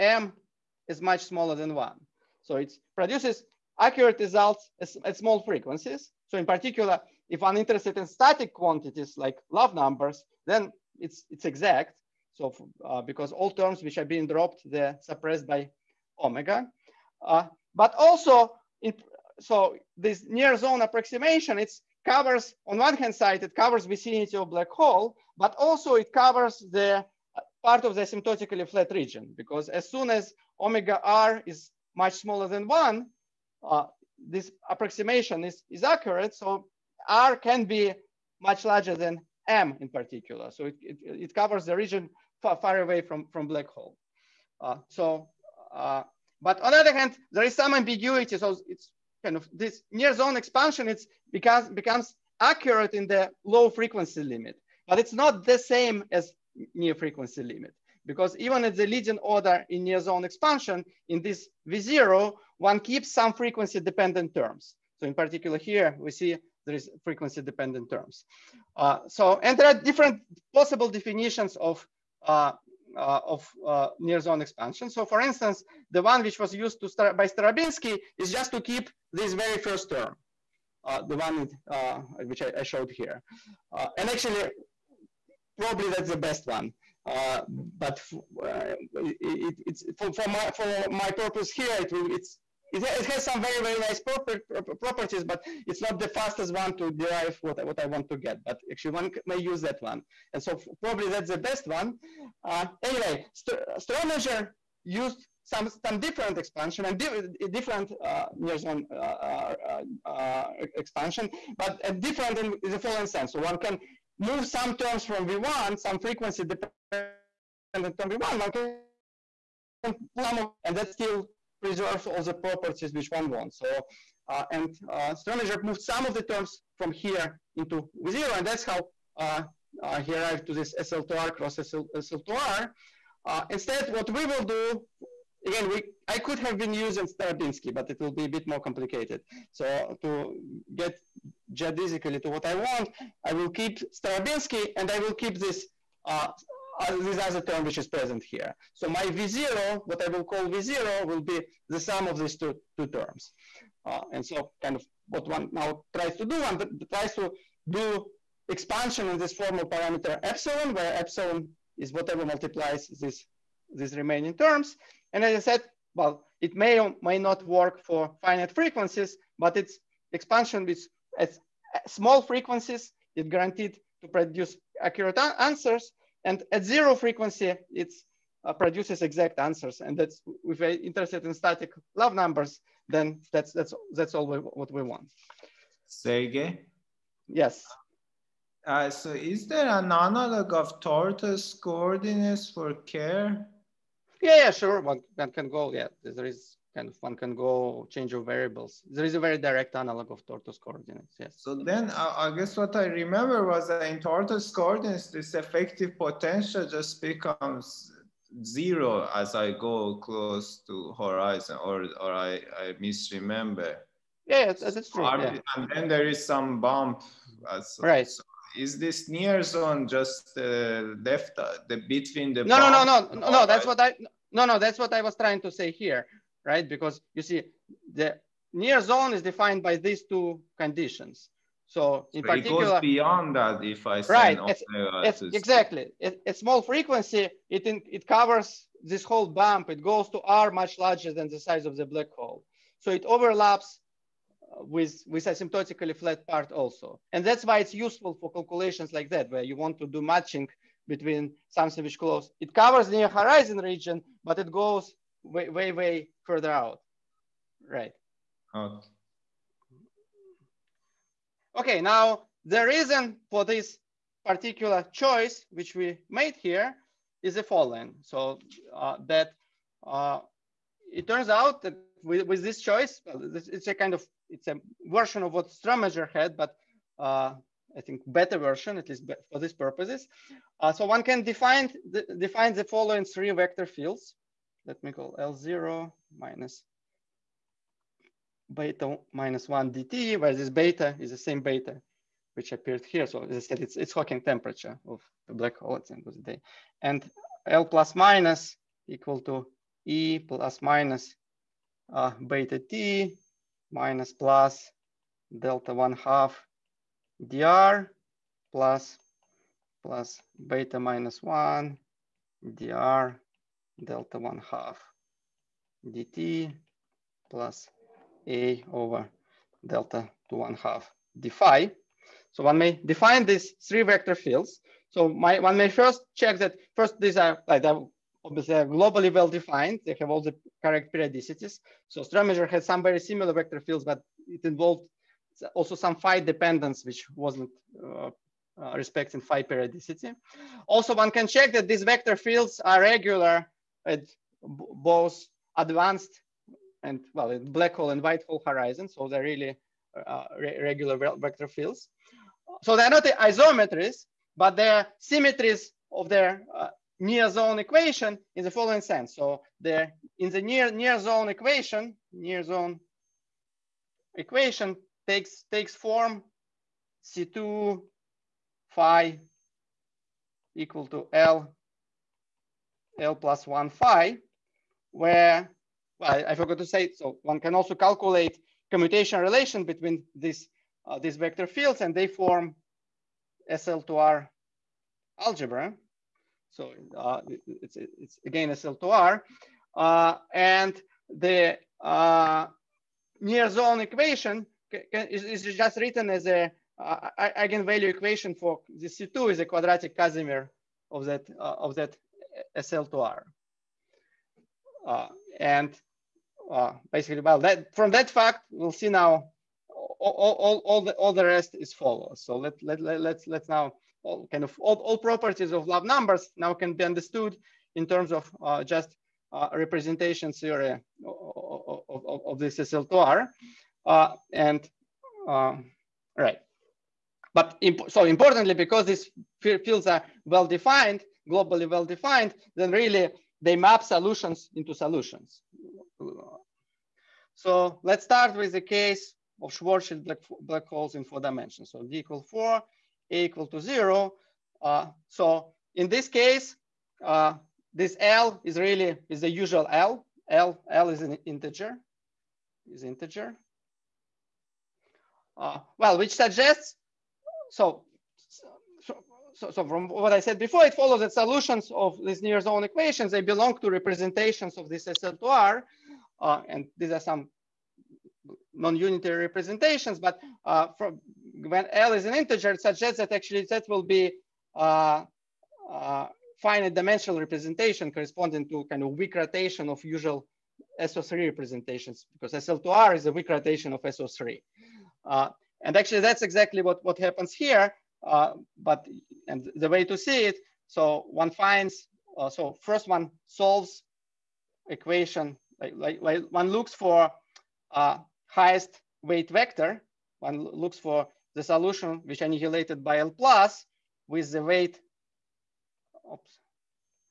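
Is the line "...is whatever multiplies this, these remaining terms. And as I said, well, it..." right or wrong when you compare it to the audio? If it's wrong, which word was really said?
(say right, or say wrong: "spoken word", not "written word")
right.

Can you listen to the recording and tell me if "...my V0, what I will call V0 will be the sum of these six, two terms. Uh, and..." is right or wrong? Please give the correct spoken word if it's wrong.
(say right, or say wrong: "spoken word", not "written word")
wrong: "two", not "six".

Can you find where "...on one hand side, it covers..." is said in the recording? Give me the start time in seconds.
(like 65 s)
22 s.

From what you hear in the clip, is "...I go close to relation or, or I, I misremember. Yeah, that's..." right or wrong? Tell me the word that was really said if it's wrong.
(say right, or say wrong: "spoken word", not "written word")
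wrong: "horizon", not "relation".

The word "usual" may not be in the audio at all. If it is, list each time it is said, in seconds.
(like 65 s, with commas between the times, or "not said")
449 s, 479 s.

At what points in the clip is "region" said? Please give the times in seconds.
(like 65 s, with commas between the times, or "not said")
28 s, 41 s, 253 s.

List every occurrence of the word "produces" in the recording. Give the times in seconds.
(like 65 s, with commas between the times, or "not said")
2 s, 174 s, 178 s.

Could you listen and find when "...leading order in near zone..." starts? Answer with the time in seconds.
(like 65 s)
58 s.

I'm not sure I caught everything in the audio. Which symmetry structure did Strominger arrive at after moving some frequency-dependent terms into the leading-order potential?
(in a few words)
SL2R cross SL2R.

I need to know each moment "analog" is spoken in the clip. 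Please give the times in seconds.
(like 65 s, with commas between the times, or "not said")
189 s, 199 s.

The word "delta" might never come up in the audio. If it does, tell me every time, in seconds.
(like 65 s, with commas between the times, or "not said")
305 s, 313 s, 319 s.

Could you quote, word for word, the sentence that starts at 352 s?
So they're not the isometries, but they're symmetries of their uh, near zone equation in the following sense.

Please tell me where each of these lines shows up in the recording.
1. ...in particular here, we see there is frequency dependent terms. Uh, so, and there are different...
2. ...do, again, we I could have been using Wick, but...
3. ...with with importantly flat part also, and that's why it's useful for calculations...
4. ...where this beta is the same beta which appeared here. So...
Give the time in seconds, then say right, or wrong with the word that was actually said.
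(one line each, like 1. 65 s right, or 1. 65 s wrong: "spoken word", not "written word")
1. 65 s right
2. 134 s wrong: "Starobinsky", not "Wick"
3. 244 s wrong: "asymptotically", not "importantly"
4. 290 s right.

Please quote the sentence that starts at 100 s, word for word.
And so probably that's the best one.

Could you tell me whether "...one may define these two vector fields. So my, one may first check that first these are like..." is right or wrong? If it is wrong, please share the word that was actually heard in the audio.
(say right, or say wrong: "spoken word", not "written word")
wrong: "three", not "two".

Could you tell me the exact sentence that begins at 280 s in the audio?
Uh, so one can define the, define the following three vector fields.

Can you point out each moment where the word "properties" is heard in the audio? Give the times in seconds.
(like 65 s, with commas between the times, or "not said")
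94 s, 122 s, 414 s.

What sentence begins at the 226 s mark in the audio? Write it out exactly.
Because you see the near zone is defined by these two conditions.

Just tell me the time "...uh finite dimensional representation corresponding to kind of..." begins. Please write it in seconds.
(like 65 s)
475 s.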